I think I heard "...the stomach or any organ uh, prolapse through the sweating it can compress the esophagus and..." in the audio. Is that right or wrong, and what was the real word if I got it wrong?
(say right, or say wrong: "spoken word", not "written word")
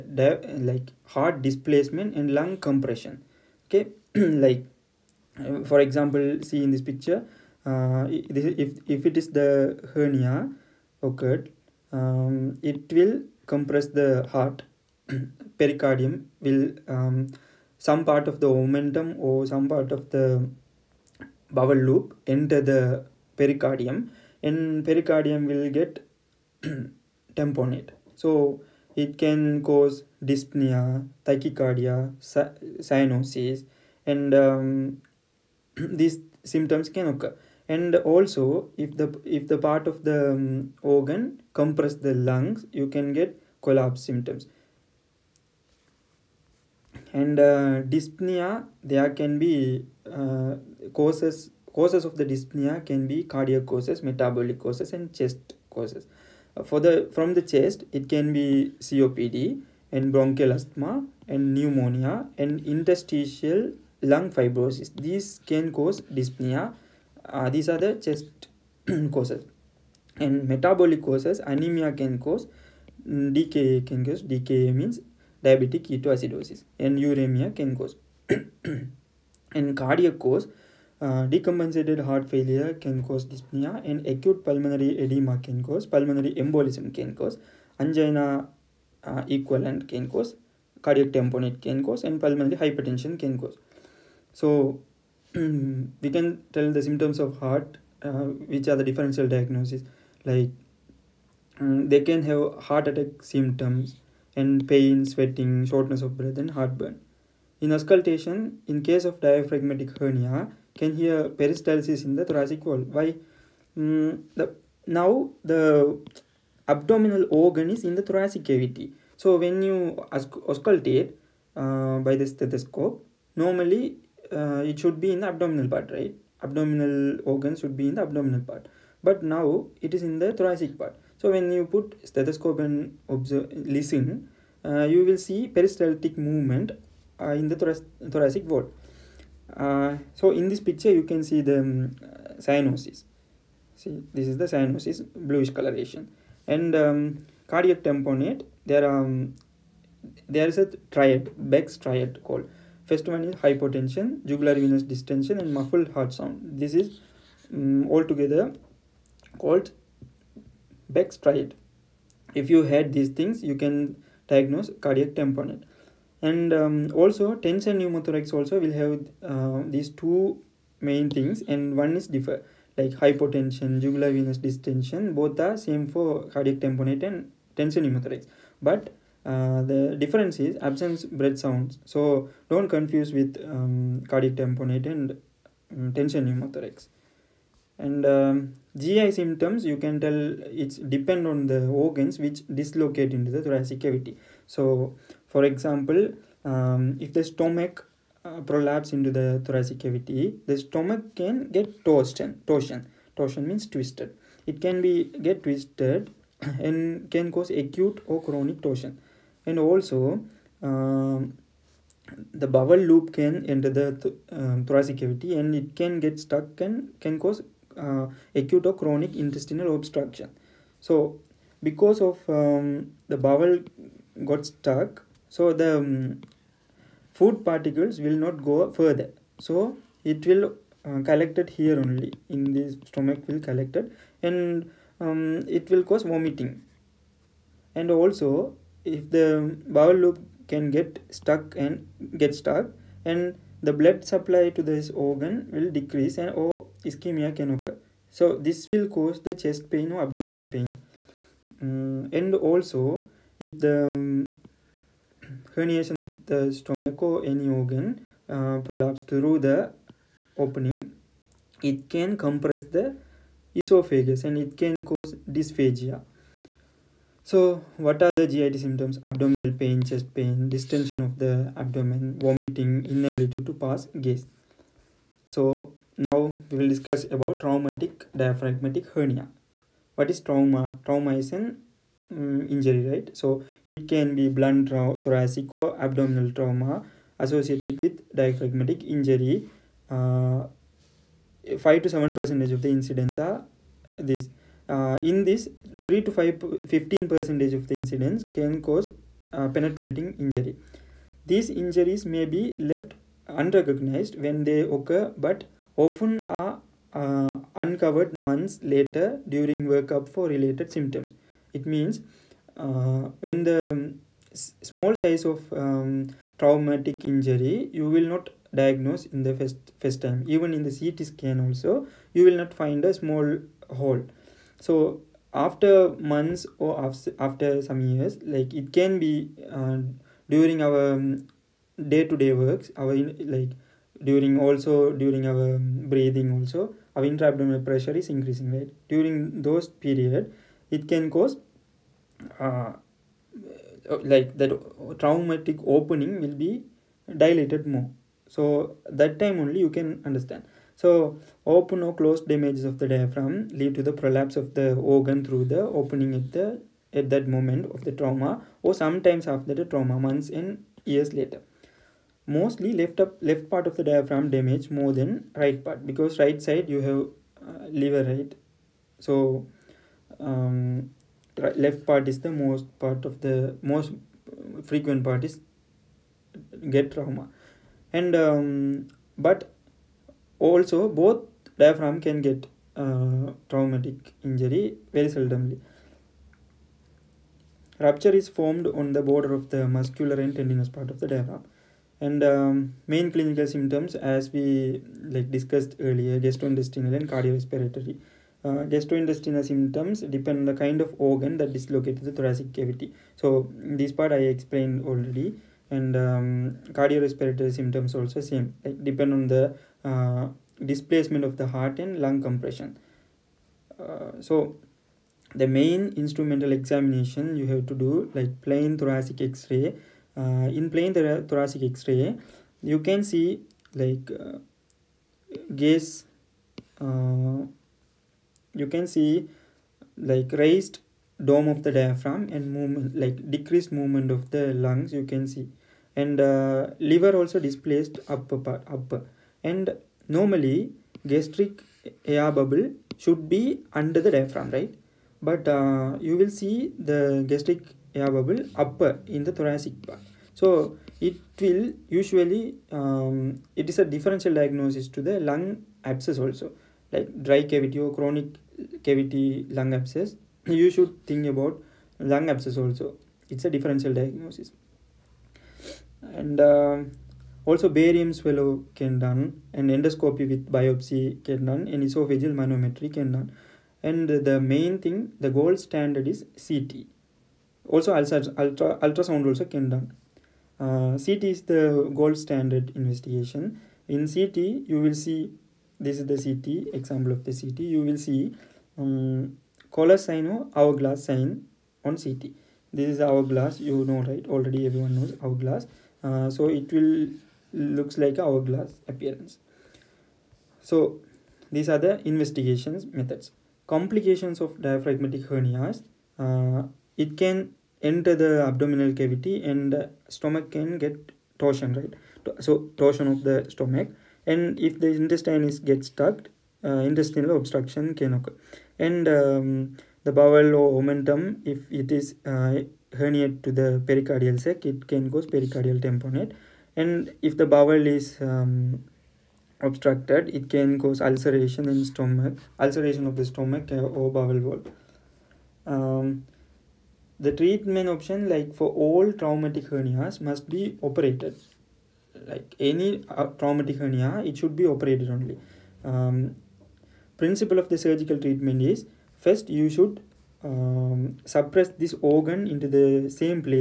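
wrong: "opening", not "sweating".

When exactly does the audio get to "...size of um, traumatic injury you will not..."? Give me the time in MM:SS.
05:14.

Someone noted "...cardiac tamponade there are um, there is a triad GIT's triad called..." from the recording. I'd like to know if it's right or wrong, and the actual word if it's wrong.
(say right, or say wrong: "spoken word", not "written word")
wrong: "Beck", not "GIT".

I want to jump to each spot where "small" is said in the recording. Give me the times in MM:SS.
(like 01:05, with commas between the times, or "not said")
05:14, 05:22.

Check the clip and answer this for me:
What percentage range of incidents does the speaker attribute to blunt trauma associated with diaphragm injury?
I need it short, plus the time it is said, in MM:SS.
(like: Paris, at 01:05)
5 to 7 percent, at 04:51.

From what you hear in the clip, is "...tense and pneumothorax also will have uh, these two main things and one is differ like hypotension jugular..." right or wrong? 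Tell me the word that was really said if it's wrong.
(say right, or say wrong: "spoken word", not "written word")
right.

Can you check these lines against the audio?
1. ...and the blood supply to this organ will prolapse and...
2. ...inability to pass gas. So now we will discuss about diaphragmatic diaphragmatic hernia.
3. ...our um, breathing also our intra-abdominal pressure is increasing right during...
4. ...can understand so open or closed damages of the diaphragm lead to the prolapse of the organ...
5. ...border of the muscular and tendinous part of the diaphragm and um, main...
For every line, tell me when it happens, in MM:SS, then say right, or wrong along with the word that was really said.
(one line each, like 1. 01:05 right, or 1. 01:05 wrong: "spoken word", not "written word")
1. 04:03 wrong: "decrease", not "prolapse"
2. 04:32 wrong: "traumatic", not "diaphragmatic"
3. 05:35 right
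4. 05:49 right
5. 06:29 right.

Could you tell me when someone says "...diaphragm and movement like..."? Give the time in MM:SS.
07:11.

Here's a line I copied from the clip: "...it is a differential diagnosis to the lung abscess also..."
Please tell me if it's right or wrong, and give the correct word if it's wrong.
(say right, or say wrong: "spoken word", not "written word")
right.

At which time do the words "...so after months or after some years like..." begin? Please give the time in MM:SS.
05:24.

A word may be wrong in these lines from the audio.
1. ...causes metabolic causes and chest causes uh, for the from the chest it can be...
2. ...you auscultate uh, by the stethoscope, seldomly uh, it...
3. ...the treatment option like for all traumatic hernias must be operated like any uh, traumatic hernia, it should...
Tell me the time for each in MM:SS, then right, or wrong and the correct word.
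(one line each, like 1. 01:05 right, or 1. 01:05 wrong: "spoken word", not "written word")
1. 00:53 right
2. 01:59 wrong: "normally", not "seldomly"
3. 08:57 right.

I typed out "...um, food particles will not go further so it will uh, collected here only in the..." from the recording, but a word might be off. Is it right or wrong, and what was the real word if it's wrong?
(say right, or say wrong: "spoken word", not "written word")
right.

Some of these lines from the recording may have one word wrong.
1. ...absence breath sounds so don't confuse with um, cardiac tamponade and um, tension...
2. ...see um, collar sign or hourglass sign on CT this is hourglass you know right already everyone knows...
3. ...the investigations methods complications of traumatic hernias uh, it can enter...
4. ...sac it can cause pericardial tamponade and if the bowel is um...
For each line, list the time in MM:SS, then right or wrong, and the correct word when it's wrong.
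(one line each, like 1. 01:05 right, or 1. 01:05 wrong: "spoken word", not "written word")
1. 03:00 right
2. 08:07 right
3. 08:21 wrong: "diaphragmatic", not "traumatic"
4. 08:44 right.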